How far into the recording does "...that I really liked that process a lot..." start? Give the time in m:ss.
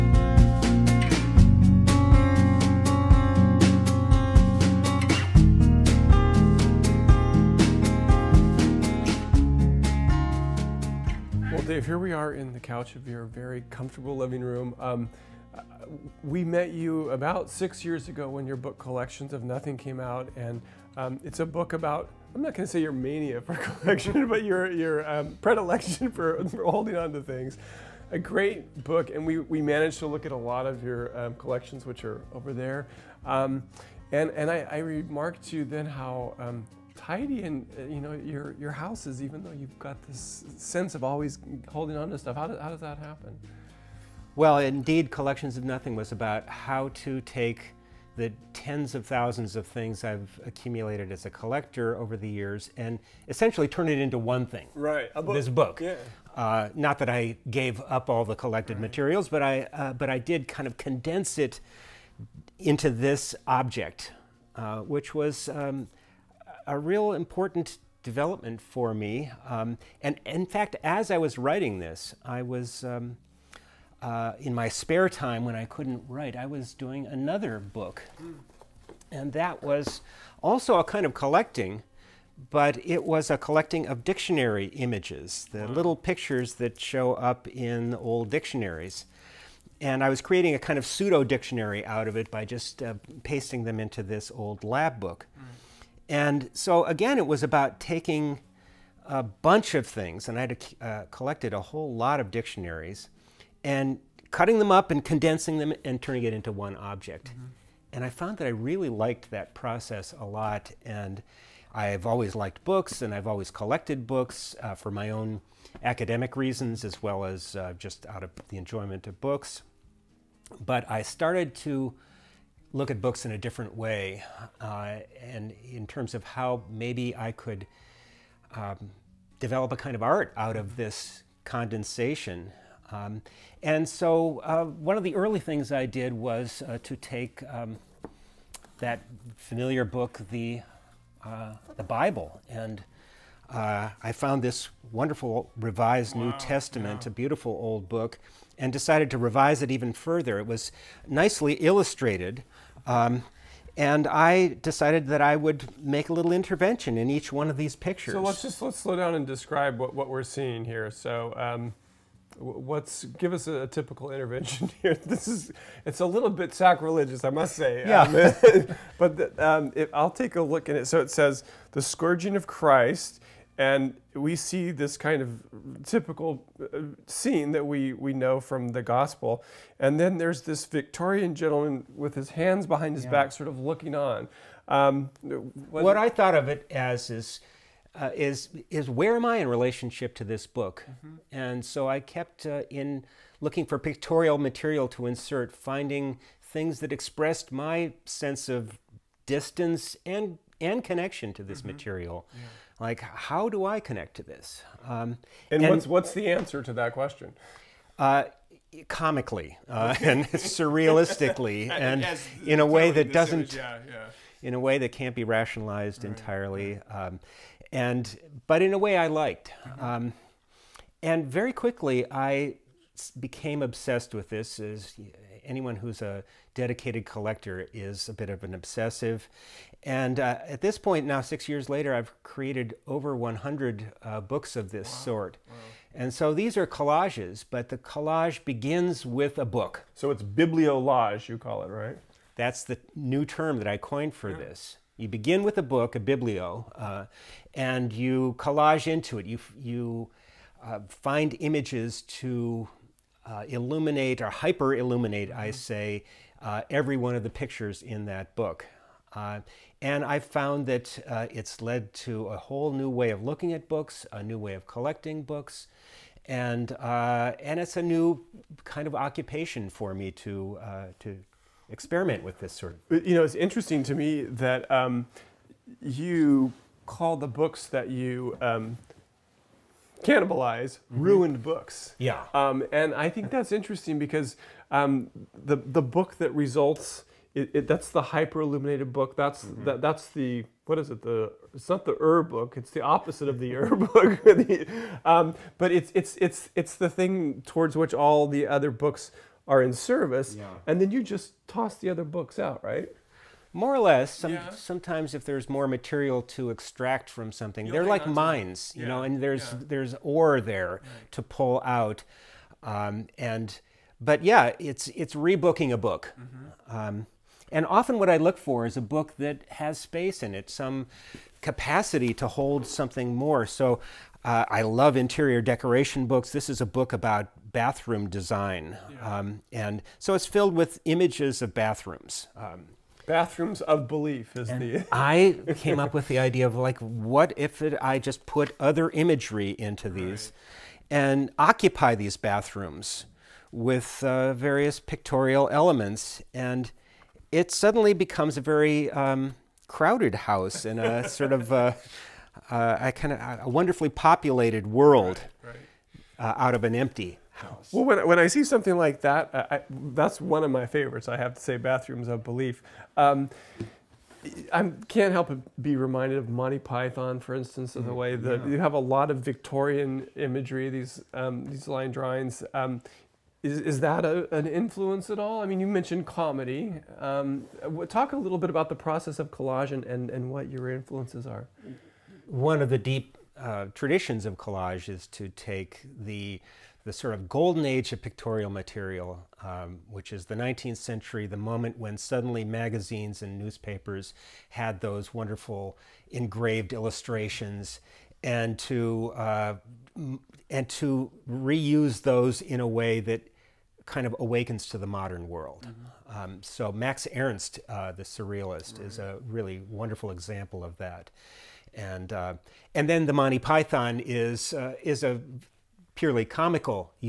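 1:48.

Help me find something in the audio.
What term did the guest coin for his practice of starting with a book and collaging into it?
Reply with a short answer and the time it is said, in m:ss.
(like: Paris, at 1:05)
bibliolage, at 4:00.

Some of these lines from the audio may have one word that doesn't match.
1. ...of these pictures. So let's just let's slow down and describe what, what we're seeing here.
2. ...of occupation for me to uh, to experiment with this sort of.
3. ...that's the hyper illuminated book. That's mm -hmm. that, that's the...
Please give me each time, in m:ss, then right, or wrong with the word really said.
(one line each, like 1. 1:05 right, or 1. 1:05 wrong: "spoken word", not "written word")
1. 2:37 right
2. 4:28 right
3. 4:47 right.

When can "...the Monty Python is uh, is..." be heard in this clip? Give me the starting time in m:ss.
6:53.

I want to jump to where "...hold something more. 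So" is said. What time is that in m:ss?
5:22.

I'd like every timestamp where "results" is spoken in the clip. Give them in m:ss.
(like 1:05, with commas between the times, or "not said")
4:46.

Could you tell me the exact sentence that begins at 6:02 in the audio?
Um, I can't help but be reminded of Monty Python, for instance, of the mm, way that yeah.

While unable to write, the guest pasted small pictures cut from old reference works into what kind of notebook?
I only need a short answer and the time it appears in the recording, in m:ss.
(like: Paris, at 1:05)
old lab book, at 1:34.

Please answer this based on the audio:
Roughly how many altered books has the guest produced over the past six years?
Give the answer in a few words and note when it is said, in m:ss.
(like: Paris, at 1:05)
over 100, at 3:52.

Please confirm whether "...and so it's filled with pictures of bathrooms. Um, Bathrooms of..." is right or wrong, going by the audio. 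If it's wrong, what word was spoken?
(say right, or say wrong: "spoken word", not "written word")
wrong: "images", not "pictures".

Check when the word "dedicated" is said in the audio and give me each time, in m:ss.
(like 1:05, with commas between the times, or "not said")
3:46.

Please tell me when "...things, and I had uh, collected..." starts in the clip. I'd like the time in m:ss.
1:39.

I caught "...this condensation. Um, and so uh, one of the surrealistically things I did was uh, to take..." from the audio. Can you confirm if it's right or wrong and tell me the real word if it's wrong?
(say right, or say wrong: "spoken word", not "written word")
wrong: "early", not "surrealistically".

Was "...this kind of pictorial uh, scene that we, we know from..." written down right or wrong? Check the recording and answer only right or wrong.
wrong.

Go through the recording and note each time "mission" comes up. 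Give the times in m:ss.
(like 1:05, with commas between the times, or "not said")
not said.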